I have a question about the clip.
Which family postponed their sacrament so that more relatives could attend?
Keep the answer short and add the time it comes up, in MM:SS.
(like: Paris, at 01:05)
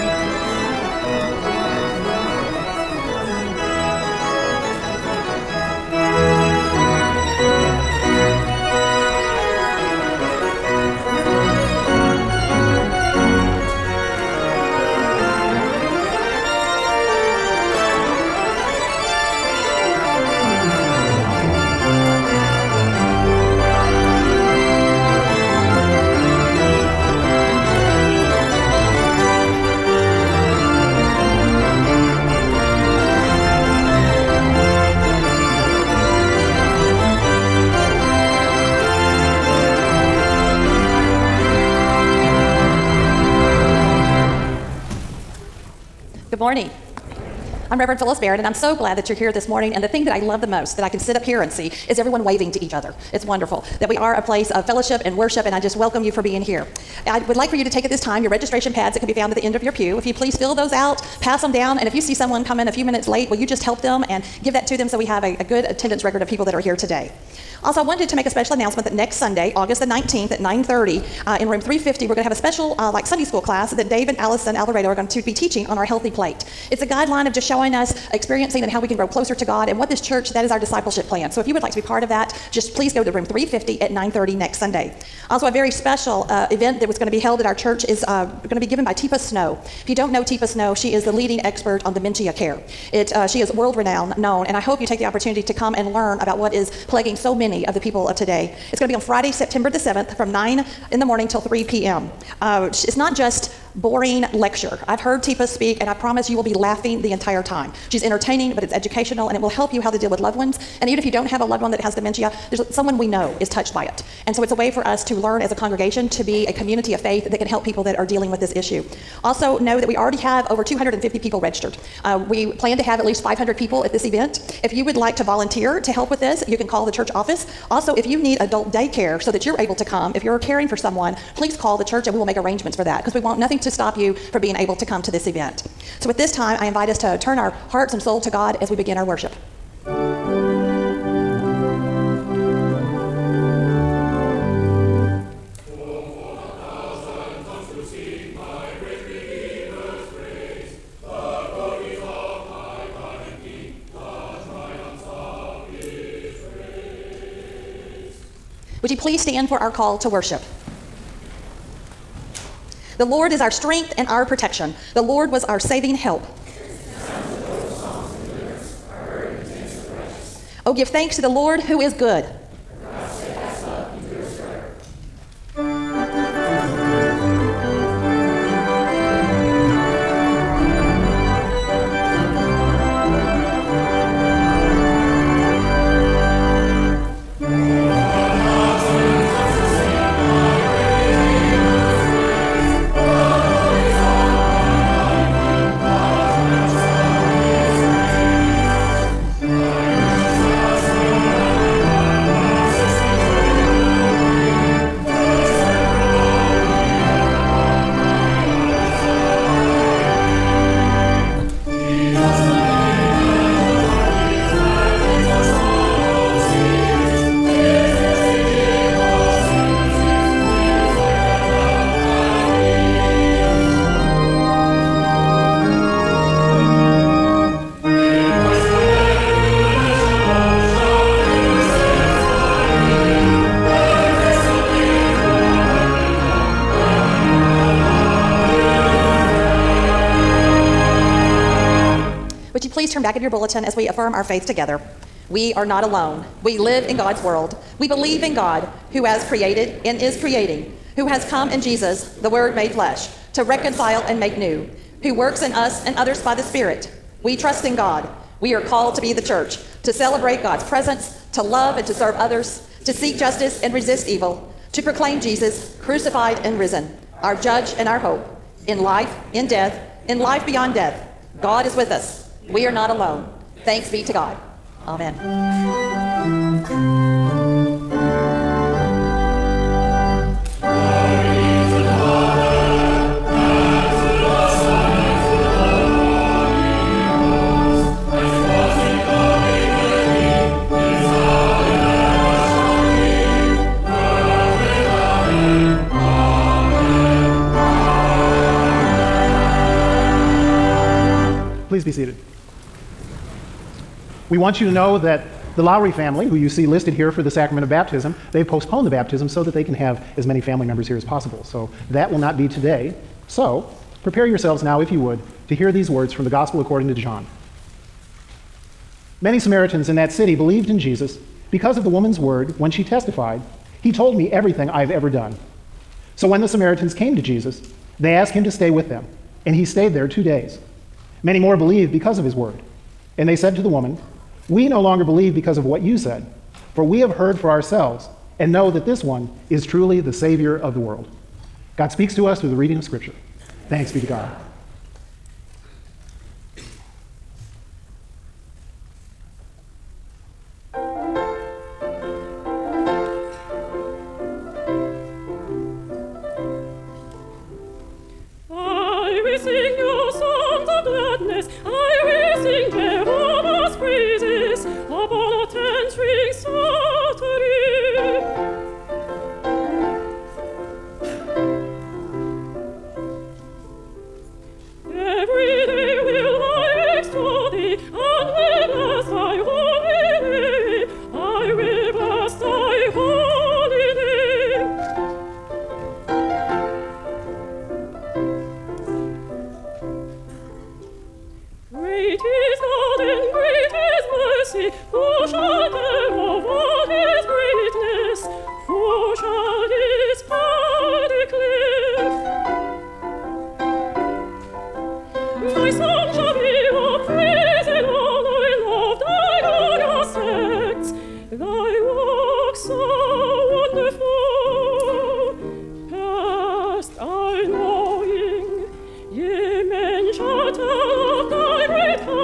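Lowry, at 05:05.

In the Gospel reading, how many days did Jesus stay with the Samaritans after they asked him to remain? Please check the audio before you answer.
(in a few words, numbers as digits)
2.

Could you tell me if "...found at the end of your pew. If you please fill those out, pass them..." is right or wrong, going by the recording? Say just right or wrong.
right.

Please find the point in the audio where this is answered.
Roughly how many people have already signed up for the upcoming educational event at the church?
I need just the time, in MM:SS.
02:00.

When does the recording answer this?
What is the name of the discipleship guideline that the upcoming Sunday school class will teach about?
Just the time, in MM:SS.
01:15.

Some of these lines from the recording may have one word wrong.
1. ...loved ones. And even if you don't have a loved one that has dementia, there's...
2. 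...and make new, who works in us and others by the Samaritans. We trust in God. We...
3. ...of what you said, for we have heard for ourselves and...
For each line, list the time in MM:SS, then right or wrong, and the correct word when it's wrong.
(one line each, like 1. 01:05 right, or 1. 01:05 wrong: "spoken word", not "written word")
1. 01:50 right
2. 04:14 wrong: "Spirit", not "Samaritans"
3. 05:35 right.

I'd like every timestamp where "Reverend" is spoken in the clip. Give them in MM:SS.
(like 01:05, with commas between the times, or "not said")
00:47.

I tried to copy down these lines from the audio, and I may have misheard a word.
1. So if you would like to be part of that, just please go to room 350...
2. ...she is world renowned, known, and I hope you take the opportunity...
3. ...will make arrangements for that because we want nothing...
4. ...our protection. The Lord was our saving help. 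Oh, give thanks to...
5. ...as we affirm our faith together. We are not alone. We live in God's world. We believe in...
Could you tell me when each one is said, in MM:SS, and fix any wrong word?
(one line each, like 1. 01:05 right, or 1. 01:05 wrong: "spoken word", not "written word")
1. 01:21 right
2. 01:33 right
3. 02:12 right
4. 02:44 right
5. 04:03 right.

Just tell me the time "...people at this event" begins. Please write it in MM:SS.
02:03.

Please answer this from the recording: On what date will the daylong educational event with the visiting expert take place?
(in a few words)
September 7.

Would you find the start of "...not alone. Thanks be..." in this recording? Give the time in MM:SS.
04:32.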